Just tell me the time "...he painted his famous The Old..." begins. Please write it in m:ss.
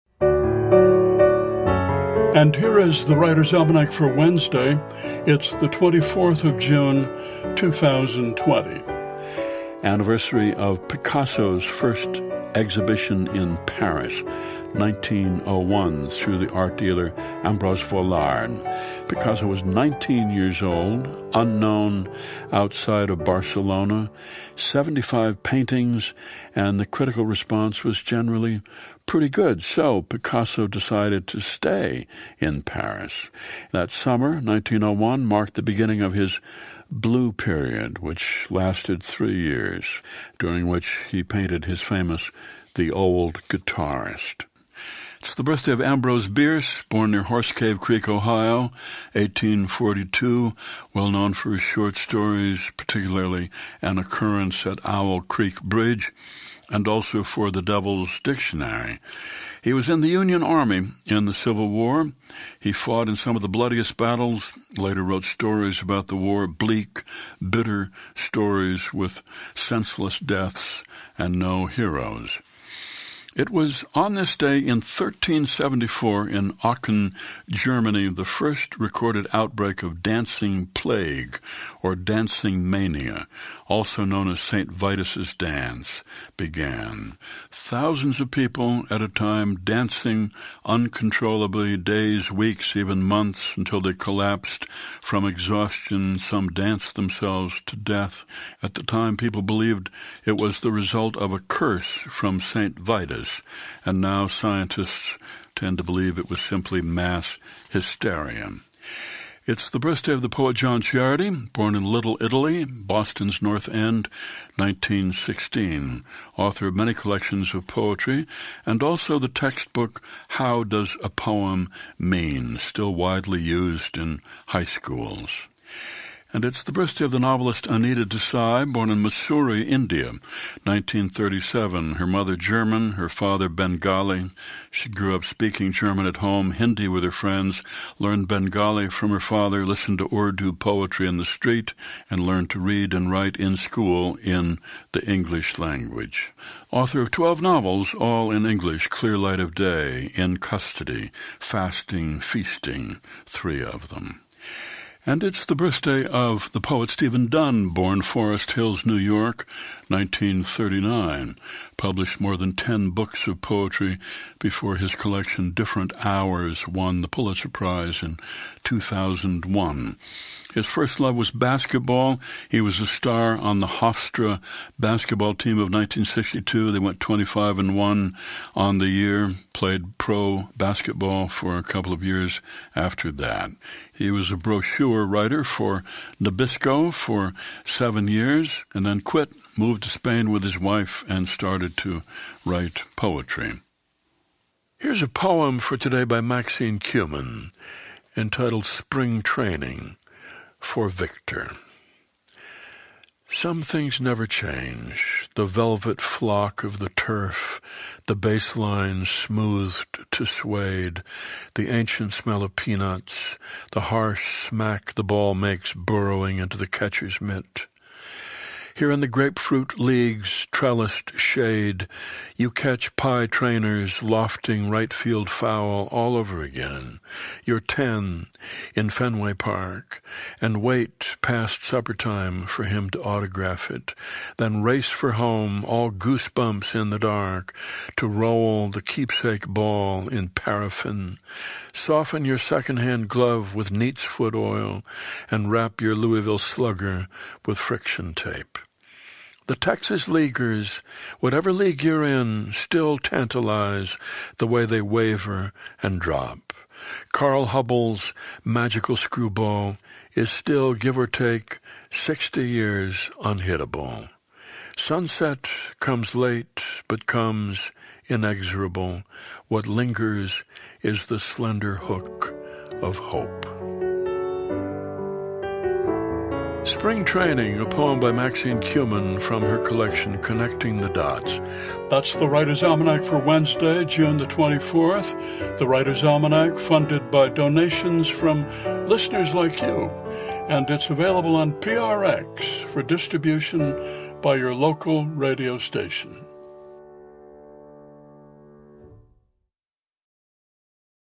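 0:41.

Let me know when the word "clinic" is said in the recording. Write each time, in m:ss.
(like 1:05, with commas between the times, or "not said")
not said.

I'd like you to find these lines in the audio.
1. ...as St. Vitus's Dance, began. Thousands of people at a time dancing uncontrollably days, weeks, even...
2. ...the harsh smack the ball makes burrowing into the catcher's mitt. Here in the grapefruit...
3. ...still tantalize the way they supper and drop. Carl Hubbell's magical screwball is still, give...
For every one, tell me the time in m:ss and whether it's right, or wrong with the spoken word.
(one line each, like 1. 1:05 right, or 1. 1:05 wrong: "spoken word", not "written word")
1. 1:24 right
2. 3:33 right
3. 4:12 wrong: "waver", not "supper".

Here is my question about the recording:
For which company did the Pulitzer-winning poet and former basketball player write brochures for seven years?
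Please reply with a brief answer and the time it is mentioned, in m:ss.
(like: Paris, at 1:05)
Nabisco, at 3:06.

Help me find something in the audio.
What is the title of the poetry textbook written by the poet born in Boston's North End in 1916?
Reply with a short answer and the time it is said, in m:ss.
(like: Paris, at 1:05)
How Does a Poem Mean, at 2:00.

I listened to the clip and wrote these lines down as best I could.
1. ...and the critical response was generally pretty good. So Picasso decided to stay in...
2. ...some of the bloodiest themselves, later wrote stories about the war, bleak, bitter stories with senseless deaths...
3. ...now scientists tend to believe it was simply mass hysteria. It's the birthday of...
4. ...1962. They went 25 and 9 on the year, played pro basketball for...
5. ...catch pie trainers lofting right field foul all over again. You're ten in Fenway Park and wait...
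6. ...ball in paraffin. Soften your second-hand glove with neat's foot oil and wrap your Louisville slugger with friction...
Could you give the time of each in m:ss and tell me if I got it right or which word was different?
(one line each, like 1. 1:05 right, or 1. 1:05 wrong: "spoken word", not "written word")
1. 0:26 right
2. 1:03 wrong: "battles", not "themselves"
3. 1:44 right
4. 2:55 wrong: "1", not "9"
5. 3:42 right
6. 3:59 right.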